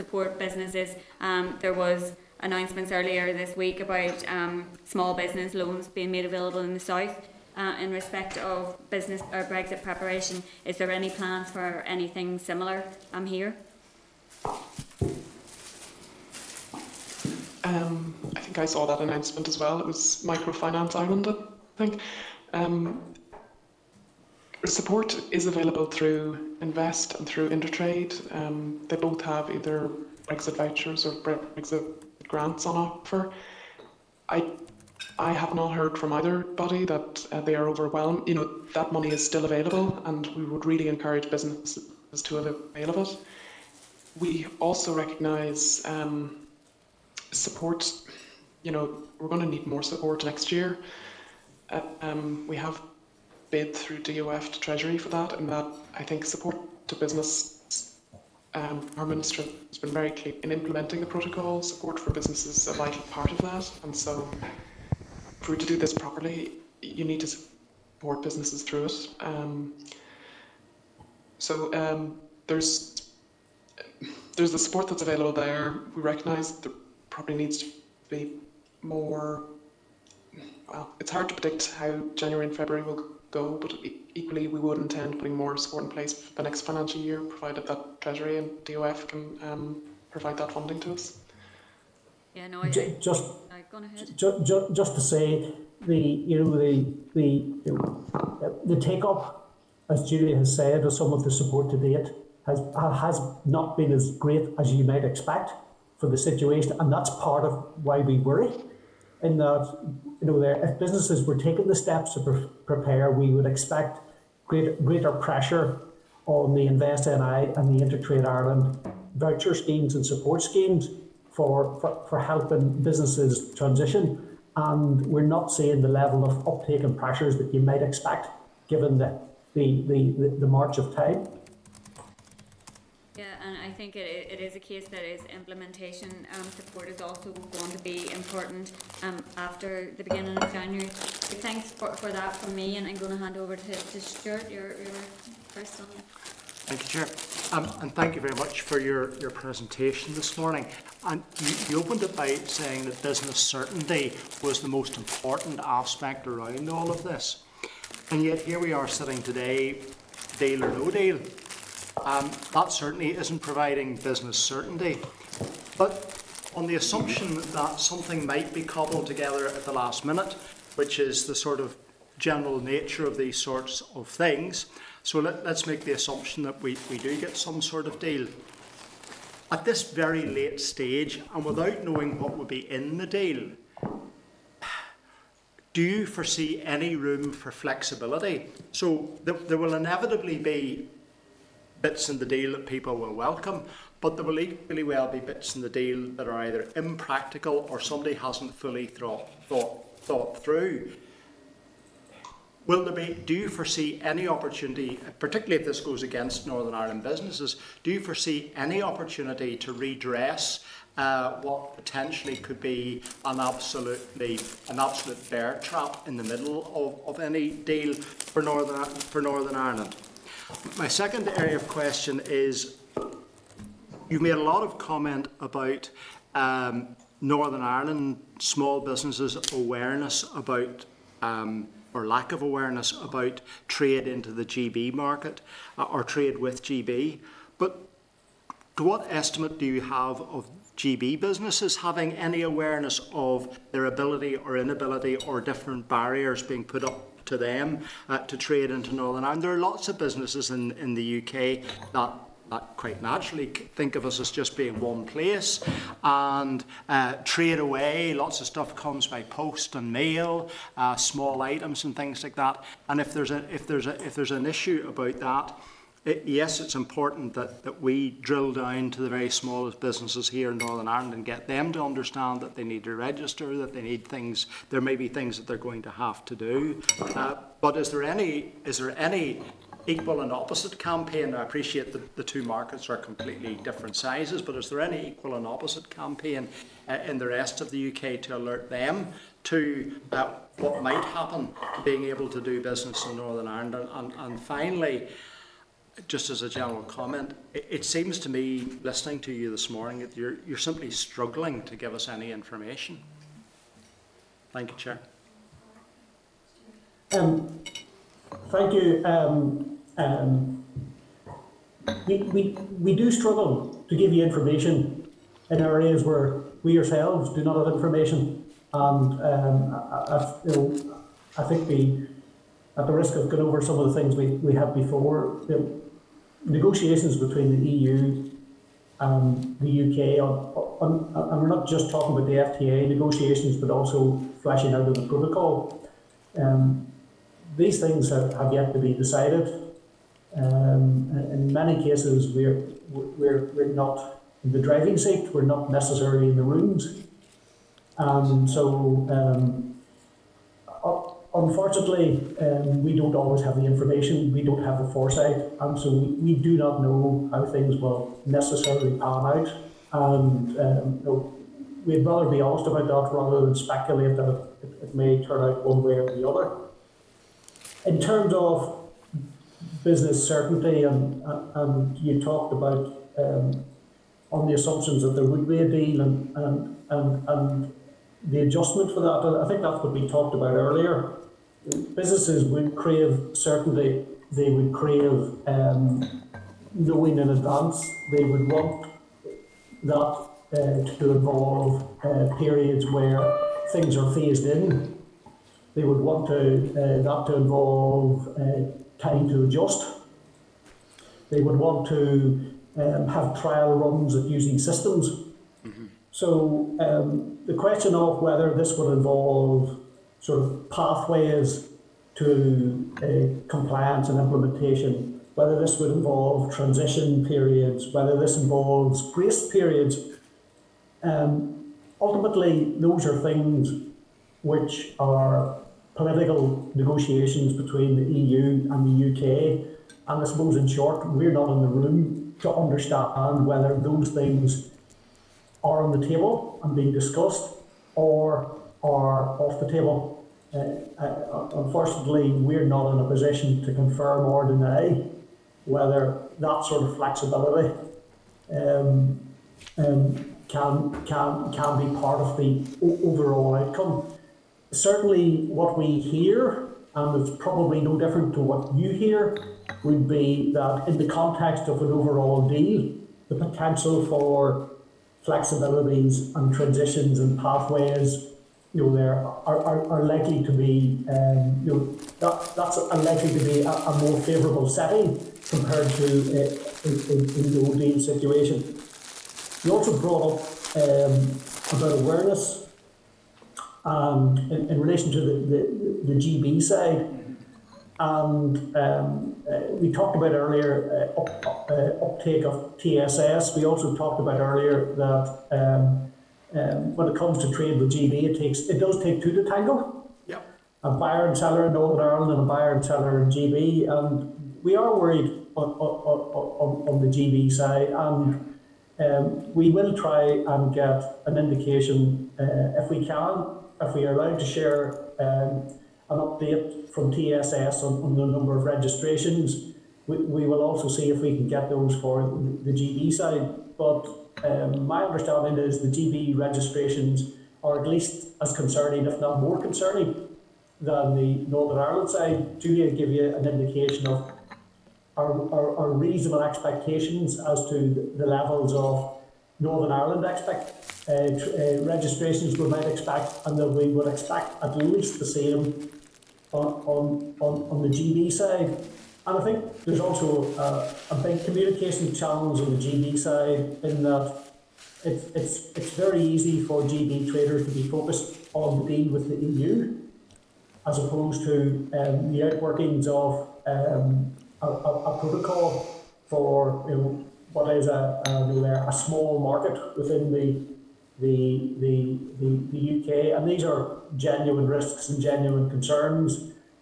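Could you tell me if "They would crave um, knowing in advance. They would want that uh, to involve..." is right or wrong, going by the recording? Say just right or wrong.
right.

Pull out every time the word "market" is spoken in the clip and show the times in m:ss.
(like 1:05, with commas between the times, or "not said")
3:54, 4:42, 9:29.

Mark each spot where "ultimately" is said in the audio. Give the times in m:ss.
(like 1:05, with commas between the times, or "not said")
7:01.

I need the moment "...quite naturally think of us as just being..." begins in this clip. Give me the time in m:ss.
4:12.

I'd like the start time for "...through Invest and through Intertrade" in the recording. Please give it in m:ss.
0:25.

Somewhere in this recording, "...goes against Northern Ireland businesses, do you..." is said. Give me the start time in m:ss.
3:25.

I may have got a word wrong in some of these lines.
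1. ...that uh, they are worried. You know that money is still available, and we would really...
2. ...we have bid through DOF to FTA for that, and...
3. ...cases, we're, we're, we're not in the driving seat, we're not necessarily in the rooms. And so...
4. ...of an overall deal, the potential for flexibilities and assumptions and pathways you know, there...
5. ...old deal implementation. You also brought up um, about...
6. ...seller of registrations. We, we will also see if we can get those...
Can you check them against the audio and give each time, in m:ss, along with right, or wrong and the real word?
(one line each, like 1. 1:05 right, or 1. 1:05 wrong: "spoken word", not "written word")
1. 0:36 wrong: "overwhelmed", not "worried"
2. 0:52 wrong: "Treasury", not "FTA"
3. 5:41 right
4. 7:41 wrong: "transitions", not "assumptions"
5. 7:57 wrong: "situation", not "implementation"
6. 8:38 wrong: "number", not "seller".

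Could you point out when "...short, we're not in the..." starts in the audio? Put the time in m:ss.
7:10.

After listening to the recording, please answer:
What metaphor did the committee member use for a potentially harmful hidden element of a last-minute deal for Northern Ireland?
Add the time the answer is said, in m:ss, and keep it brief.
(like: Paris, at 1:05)
bear trap, at 3:35.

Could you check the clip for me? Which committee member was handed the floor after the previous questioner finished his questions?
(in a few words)
Stuart.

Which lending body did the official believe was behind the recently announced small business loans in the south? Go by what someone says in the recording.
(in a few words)
Microfinance Ireland.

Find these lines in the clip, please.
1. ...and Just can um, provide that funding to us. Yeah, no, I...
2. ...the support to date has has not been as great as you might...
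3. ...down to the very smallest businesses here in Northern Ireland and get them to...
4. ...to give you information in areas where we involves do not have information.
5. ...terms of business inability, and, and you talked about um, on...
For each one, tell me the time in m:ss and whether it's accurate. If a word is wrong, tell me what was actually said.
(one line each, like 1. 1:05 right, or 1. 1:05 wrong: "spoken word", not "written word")
1. 1:28 wrong: "DOF", not "Just"
2. 1:41 right
3. 4:28 right
4. 5:13 wrong: "ourselves", not "involves"
5. 6:07 wrong: "certainty", not "inability".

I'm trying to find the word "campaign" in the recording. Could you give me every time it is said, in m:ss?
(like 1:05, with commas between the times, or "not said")
4:40, 4:45.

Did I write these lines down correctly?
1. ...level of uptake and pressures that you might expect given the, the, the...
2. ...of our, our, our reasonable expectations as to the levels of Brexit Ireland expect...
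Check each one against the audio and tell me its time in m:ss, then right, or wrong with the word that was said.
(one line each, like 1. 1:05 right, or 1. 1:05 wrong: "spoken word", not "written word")
1. 2:05 right
2. 8:54 wrong: "Northern", not "Brexit".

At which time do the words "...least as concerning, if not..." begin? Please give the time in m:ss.
8:47.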